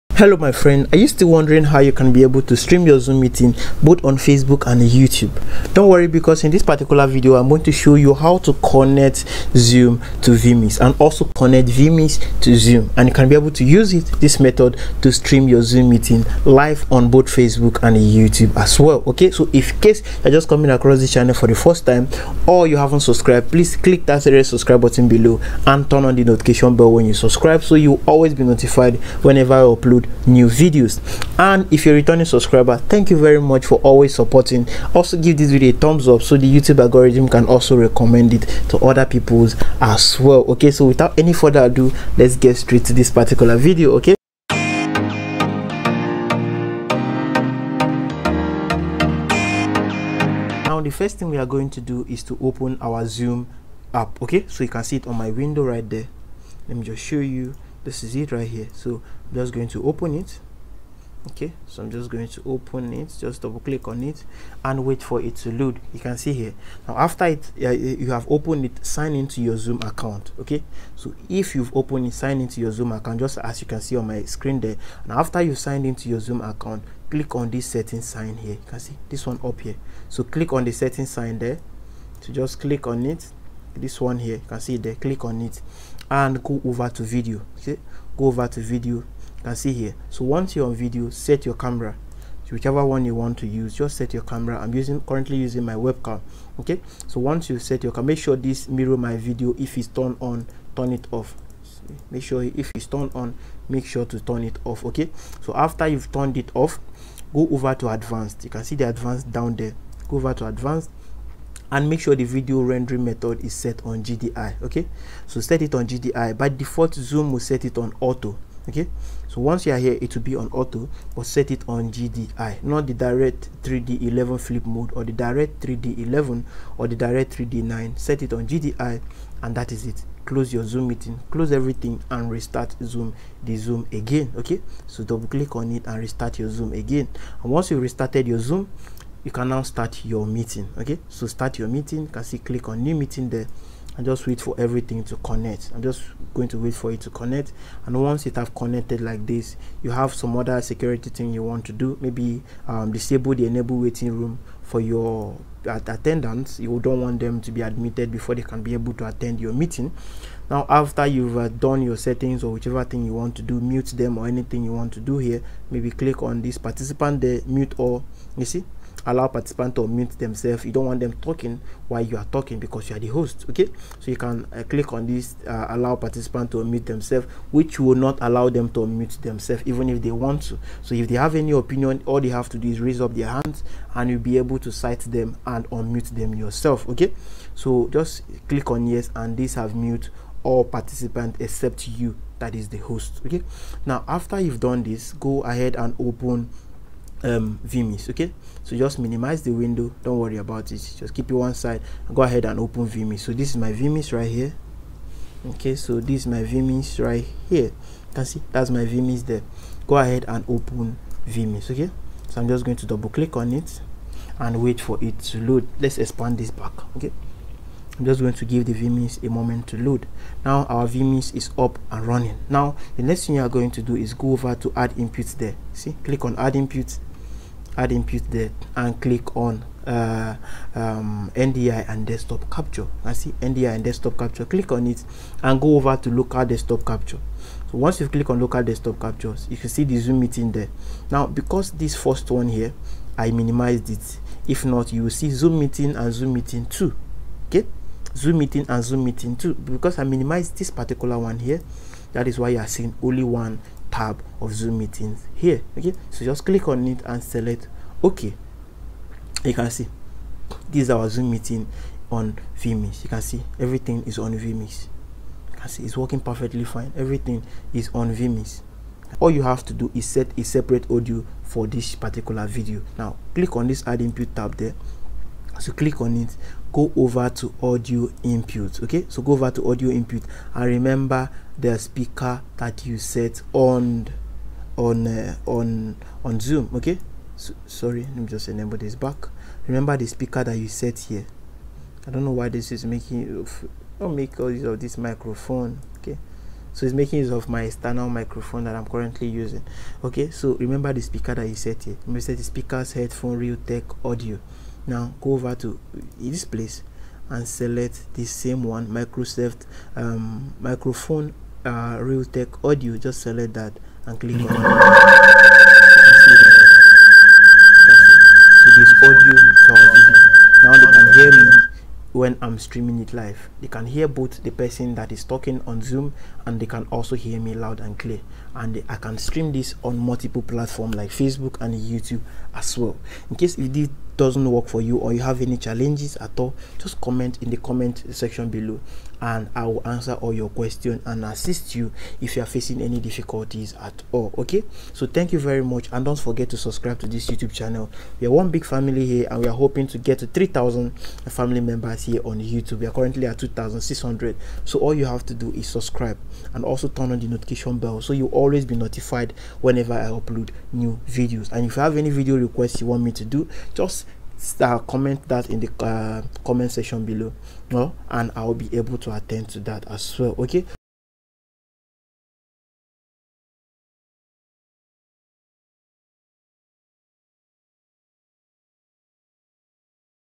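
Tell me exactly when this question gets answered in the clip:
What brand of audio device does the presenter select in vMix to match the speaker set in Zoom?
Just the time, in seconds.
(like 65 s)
311 s.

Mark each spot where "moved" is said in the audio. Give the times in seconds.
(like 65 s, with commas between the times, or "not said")
not said.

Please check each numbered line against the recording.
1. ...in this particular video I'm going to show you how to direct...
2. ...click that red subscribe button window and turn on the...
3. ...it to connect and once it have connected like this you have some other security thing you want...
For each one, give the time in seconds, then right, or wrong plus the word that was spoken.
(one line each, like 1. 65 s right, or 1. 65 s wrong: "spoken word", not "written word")
1. 6 s wrong: "connect", not "direct"
2. 23 s wrong: "below", not "window"
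3. 146 s right.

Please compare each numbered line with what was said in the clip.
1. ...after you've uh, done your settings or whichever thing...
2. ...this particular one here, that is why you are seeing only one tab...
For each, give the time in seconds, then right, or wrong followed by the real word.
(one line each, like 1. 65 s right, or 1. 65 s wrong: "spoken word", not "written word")
1. 160 s right
2. 250 s right.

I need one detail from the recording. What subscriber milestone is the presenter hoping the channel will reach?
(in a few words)
3000.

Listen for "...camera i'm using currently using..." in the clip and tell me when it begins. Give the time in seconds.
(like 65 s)
94 s.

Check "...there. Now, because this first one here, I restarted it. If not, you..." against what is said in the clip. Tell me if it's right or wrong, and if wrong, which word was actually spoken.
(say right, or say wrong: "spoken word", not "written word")
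wrong: "minimized", not "restarted".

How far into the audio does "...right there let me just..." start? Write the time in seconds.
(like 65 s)
55 s.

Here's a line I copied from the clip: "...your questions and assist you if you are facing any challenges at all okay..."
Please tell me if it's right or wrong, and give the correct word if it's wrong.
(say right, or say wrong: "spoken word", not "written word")
wrong: "difficulties", not "challenges".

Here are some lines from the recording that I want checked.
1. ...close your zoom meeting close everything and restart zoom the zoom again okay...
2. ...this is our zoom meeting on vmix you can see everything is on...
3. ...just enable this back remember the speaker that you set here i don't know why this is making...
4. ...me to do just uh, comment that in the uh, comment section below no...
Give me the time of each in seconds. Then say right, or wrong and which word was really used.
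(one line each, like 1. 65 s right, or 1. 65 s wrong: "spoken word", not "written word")
1. 130 s right
2. 260 s right
3. 288 s right
4. 363 s right.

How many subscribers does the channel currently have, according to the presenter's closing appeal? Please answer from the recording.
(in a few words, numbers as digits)
2600.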